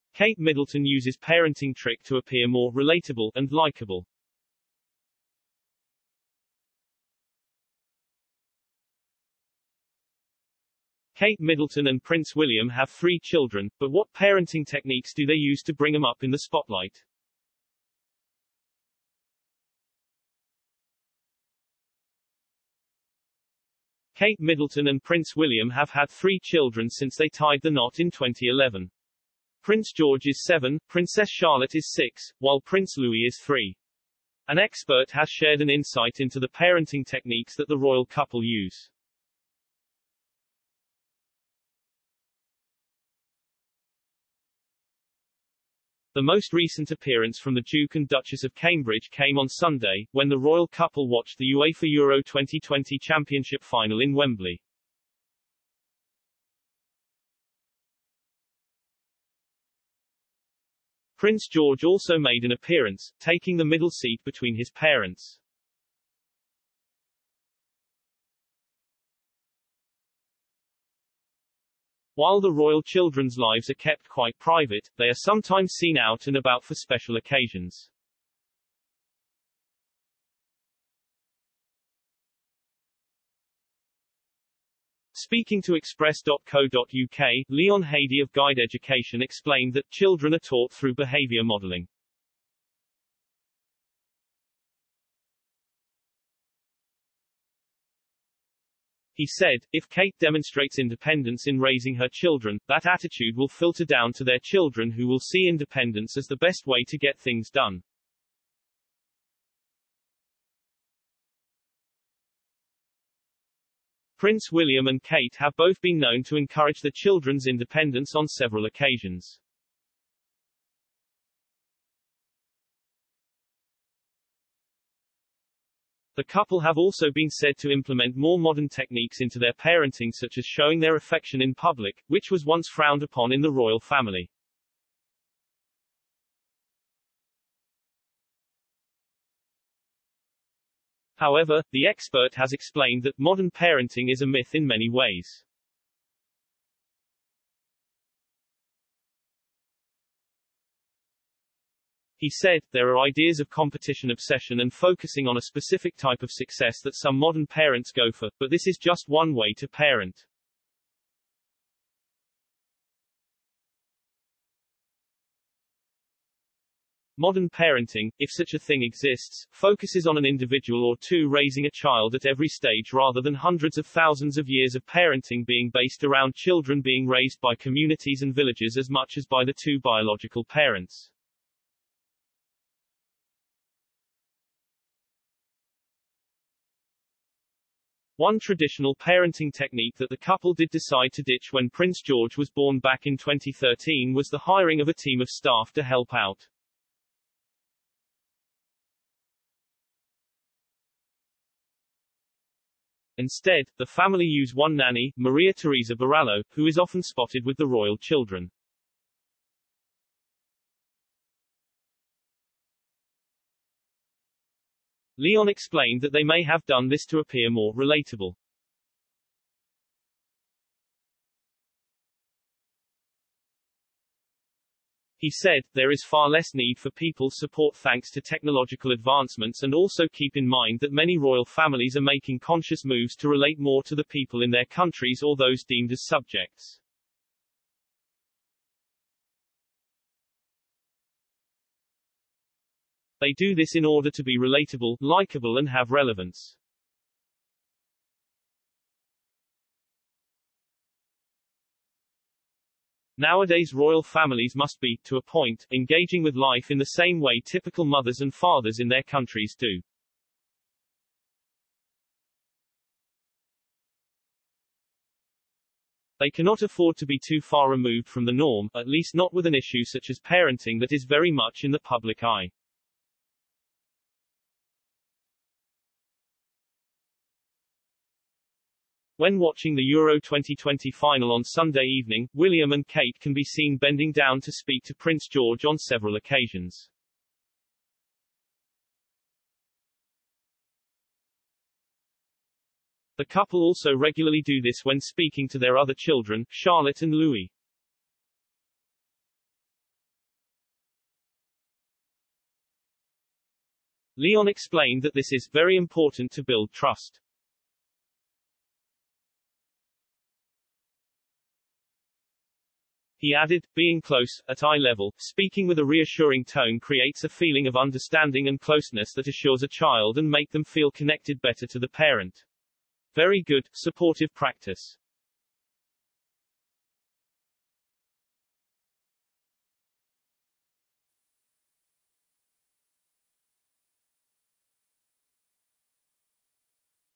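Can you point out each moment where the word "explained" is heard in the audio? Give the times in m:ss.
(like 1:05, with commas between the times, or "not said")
1:29, 2:22, 3:35, 5:04.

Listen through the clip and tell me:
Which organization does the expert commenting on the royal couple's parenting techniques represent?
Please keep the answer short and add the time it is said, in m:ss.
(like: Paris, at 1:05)
Guide Education, at 1:28.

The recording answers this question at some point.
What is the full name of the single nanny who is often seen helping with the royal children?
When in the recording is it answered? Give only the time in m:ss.
3:25.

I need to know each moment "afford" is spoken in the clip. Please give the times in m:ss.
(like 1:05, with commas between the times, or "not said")
4:26.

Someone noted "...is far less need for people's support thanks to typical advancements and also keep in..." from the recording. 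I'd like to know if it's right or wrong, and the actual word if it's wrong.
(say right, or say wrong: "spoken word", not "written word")
wrong: "technological", not "typical".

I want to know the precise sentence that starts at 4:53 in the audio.
The couple also regularly do this when speaking to their other children, Charlotte and Louis.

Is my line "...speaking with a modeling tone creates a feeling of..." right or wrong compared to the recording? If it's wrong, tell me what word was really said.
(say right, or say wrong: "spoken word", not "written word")
wrong: "reassuring", not "modeling".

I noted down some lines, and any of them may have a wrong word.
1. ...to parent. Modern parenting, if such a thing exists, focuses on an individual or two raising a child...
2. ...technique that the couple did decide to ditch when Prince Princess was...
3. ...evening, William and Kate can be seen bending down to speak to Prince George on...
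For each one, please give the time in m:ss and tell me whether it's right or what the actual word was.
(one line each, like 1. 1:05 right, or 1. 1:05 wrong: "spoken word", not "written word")
1. 2:39 right
2. 3:09 wrong: "George", not "Princess"
3. 4:41 right.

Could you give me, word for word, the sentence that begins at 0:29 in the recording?
Prince George is 7, Princess Charlotte is 6, while Prince Louis is 3.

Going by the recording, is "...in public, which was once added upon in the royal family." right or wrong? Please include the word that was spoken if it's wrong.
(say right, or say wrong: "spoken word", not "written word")
wrong: "frowned", not "added".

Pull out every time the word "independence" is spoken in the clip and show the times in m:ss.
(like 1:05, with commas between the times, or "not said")
1:40, 1:45, 1:57.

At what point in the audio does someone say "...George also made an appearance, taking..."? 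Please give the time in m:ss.
1:01.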